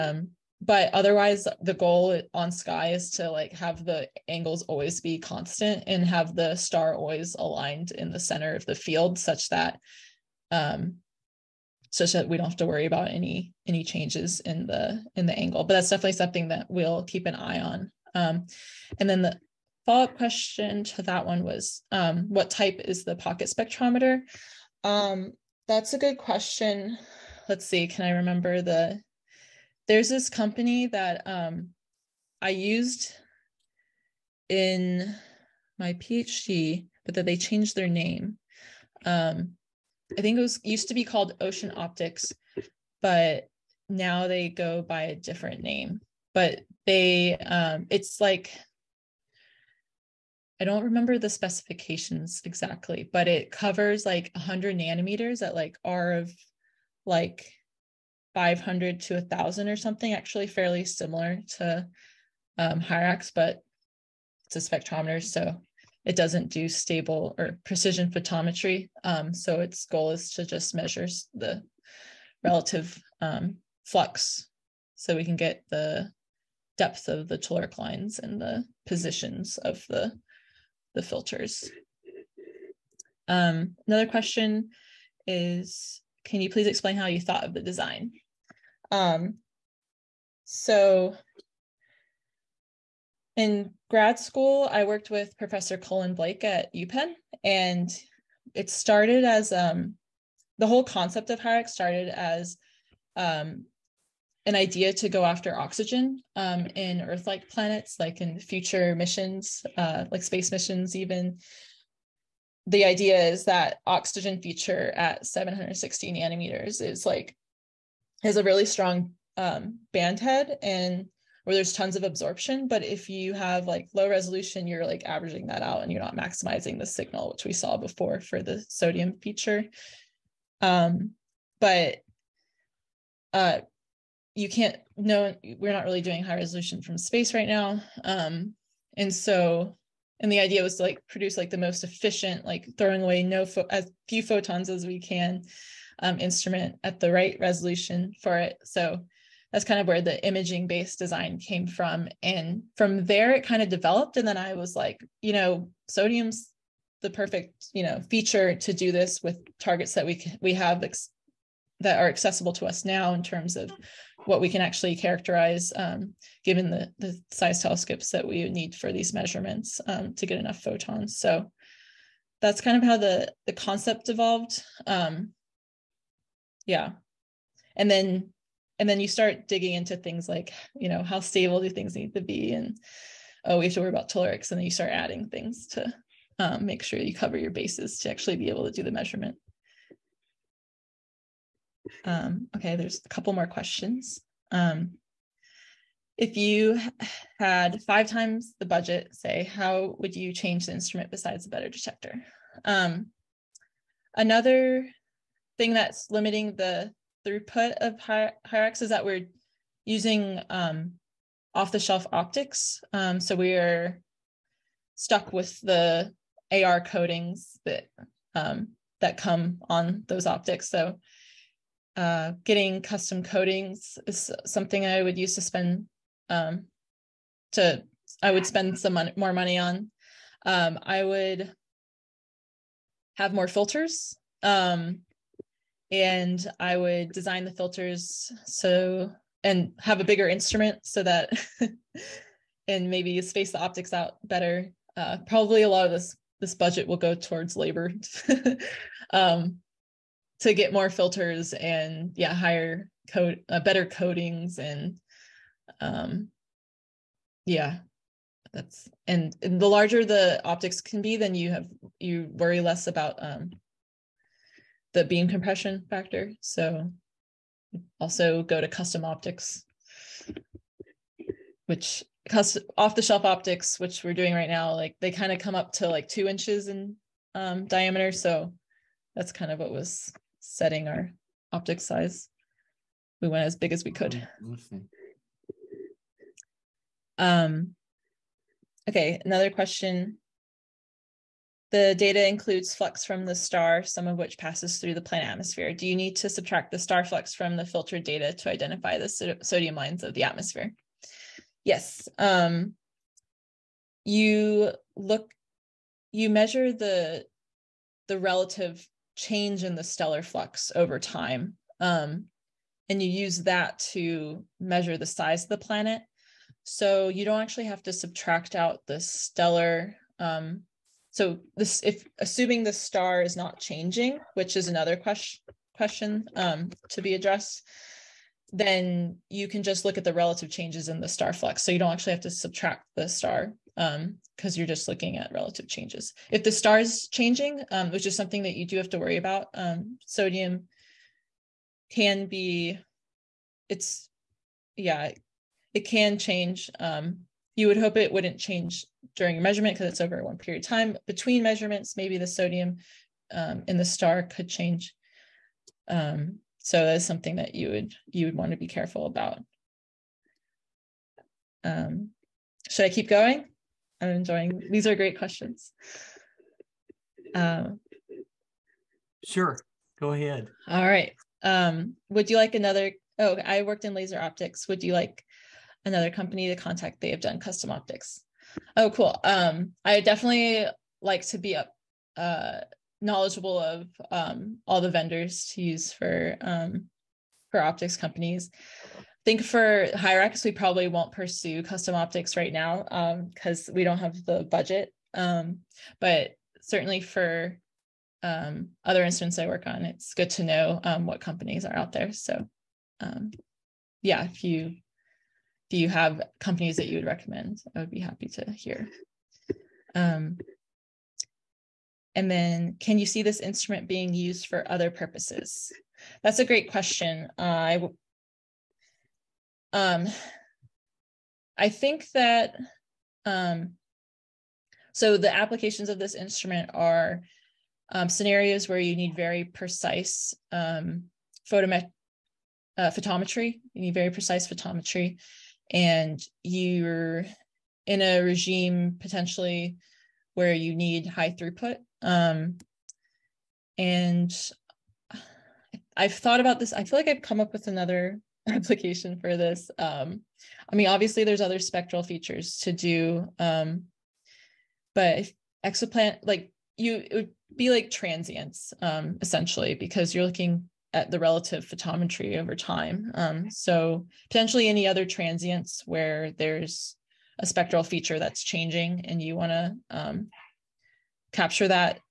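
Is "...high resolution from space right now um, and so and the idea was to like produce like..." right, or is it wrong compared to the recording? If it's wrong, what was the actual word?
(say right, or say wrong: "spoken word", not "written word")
right.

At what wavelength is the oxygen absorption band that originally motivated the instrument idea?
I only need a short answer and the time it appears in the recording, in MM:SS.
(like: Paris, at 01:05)
760 nanometers, at 01:55.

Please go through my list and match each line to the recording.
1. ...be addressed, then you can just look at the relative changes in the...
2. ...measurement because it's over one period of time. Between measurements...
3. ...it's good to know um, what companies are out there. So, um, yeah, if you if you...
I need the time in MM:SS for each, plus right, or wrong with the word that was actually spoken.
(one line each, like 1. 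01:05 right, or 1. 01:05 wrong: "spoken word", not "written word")
1. 05:27 right
2. 05:49 right
3. 06:39 right.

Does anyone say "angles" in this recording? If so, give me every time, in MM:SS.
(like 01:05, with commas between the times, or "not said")
00:04, 00:15.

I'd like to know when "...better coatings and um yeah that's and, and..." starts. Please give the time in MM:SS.
04:13.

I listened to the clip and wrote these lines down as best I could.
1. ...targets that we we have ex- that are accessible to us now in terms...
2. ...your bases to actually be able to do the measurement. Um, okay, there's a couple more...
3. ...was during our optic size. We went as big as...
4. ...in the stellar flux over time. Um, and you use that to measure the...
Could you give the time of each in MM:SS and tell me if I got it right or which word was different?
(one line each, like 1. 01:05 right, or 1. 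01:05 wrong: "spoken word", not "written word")
1. 02:39 right
2. 03:07 right
3. 04:39 wrong: "setting", not "during"
4. 05:09 right.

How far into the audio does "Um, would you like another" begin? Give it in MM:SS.
06:11.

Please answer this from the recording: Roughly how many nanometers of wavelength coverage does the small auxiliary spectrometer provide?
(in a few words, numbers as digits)
100 nanometers.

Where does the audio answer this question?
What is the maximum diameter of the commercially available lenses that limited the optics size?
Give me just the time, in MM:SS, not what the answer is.
04:36.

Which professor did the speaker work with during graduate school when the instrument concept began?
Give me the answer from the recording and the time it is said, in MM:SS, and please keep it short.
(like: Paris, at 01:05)
Cullen Blake, at 01:35.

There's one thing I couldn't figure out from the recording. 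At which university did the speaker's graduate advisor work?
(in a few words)
UPenn.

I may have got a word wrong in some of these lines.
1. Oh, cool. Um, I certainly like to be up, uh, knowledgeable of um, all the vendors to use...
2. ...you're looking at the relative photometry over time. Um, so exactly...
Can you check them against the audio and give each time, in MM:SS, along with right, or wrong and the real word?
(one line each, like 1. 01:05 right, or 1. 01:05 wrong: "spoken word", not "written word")
1. 06:18 wrong: "definitely", not "certainly"
2. 07:40 wrong: "potentially", not "exactly".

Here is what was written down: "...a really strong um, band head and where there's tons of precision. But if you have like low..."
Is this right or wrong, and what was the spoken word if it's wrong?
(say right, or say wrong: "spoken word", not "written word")
wrong: "absorption", not "precision".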